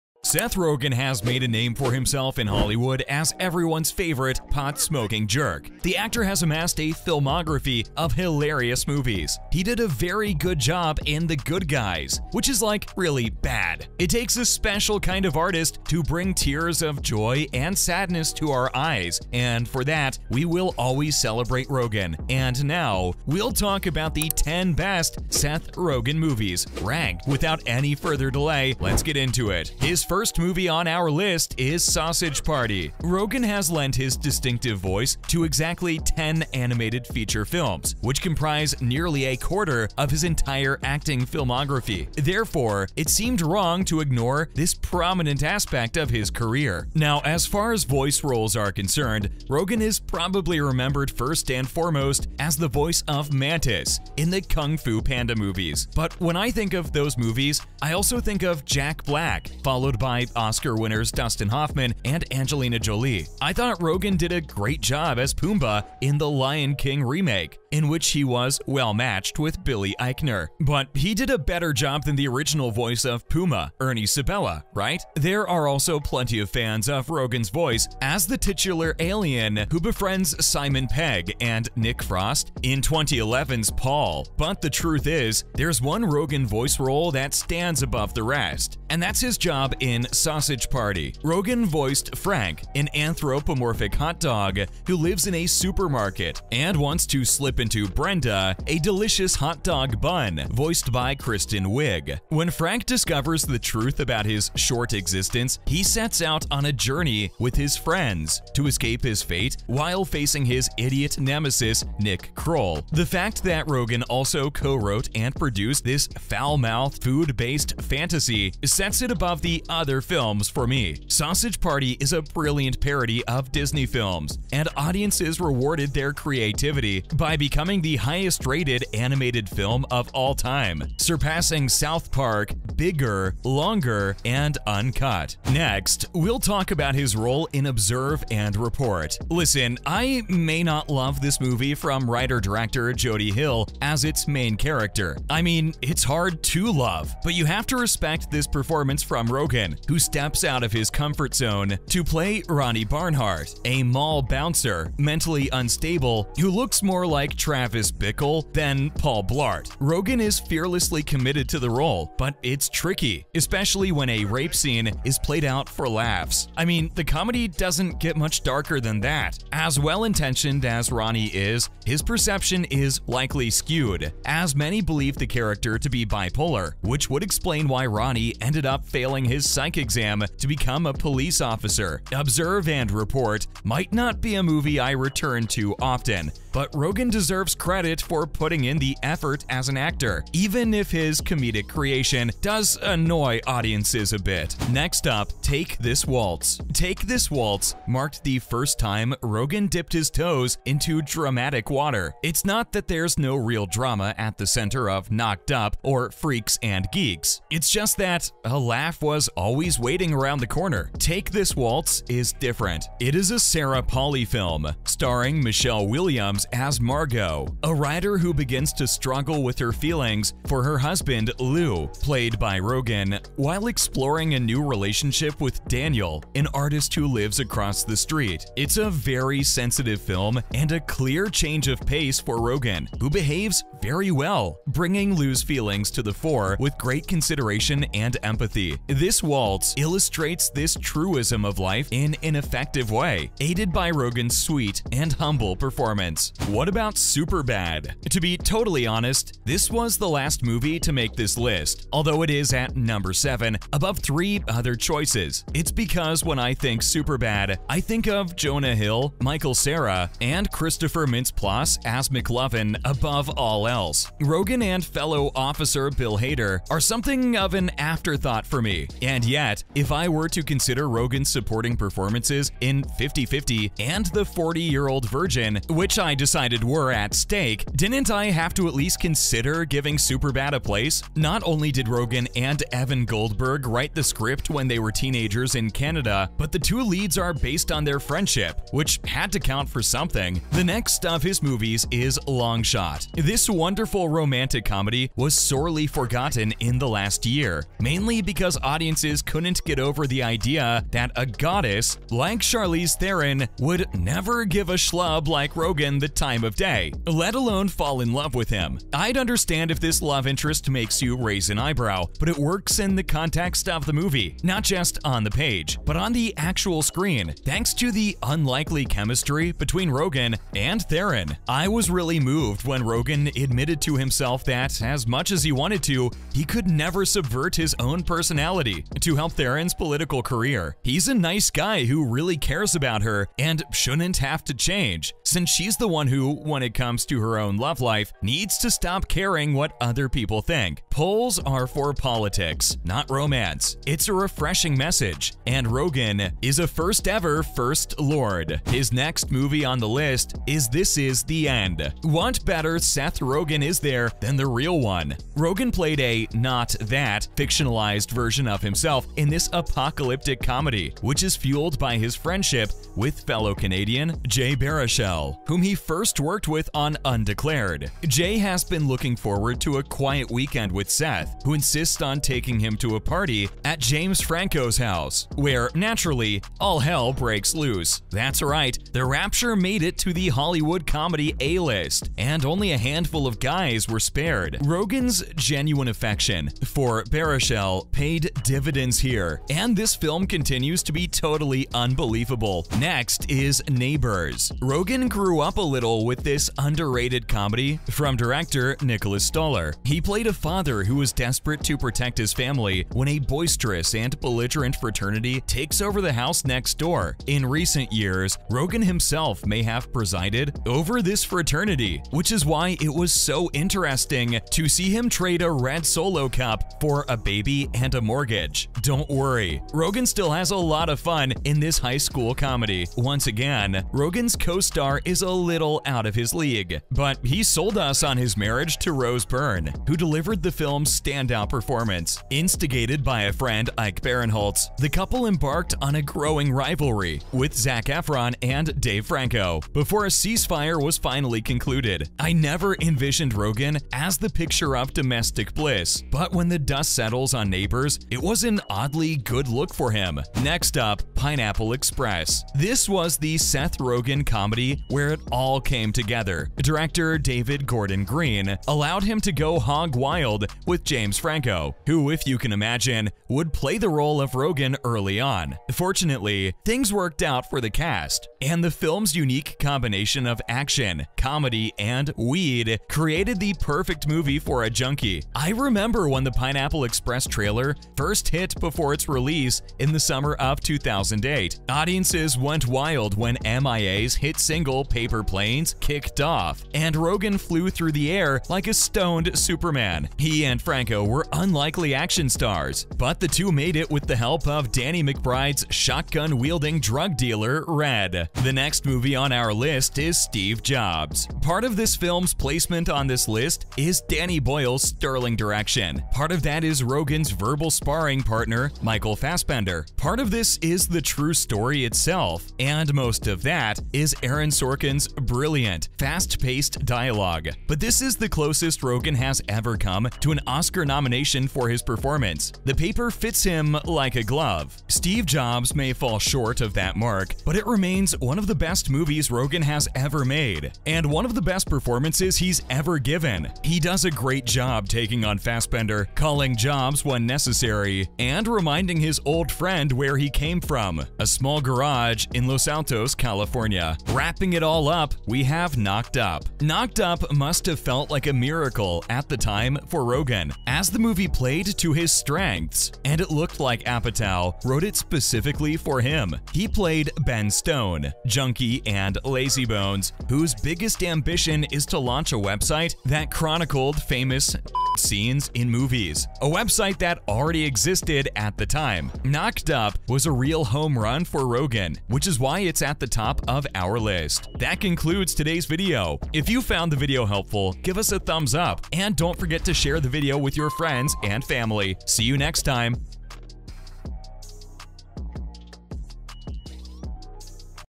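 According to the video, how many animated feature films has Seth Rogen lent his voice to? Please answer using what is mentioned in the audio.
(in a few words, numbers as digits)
10.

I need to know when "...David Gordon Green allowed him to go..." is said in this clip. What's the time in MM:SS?
07:37.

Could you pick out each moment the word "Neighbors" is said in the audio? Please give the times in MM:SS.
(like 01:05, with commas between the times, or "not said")
06:33, 07:27.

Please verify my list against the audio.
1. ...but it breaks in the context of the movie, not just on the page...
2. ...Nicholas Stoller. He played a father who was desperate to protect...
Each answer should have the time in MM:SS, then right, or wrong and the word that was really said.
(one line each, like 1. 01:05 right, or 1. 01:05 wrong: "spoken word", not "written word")
1. 05:12 wrong: "works", not "breaks"
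2. 06:38 right.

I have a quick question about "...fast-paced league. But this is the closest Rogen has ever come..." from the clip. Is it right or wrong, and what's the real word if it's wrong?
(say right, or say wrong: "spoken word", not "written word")
wrong: "dialogue", not "league".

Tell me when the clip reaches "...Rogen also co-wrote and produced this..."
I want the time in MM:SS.
01:53.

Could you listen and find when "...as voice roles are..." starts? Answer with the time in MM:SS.
00:47.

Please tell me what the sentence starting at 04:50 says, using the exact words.
The next of his movies is Long Shot.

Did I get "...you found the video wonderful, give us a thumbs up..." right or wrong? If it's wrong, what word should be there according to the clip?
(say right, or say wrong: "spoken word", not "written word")
wrong: "helpful", not "wonderful".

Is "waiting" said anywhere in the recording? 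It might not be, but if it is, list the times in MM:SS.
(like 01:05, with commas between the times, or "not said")
03:29.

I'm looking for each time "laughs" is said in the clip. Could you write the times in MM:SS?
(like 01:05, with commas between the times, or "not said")
02:45, 03:28.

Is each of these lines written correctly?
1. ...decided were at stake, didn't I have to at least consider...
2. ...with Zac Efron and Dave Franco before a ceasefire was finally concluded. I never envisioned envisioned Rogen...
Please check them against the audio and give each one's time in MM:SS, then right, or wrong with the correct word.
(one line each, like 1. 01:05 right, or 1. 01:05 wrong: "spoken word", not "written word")
1. 04:36 right
2. 07:17 right.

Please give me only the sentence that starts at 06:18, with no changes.
That's right, The Rapture made it to the Hollywood comedy A-list, and only a handful handful of guys were spared.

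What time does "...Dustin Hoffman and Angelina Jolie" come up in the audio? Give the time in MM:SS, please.
01:01.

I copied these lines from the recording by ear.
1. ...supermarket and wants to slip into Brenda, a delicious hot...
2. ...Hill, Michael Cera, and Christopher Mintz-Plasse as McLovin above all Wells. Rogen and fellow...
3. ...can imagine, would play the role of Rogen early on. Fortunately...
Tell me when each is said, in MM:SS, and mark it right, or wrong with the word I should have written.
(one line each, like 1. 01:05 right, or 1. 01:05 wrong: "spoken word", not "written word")
1. 01:35 right
2. 04:18 right
3. 07:42 right.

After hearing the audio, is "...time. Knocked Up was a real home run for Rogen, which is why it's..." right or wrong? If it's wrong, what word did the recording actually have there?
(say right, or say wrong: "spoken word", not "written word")
right.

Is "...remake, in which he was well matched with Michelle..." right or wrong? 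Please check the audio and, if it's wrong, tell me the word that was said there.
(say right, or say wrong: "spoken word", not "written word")
wrong: "Billy", not "Michelle".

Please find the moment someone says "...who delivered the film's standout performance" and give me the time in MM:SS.
07:09.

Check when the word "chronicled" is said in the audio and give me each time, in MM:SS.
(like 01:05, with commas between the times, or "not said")
09:23.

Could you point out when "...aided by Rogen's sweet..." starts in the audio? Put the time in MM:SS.
04:03.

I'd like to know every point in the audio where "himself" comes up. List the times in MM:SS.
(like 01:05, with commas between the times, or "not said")
00:01, 05:23, 05:58, 06:48.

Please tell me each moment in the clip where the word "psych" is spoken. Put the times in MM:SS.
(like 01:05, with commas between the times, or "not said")
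02:59.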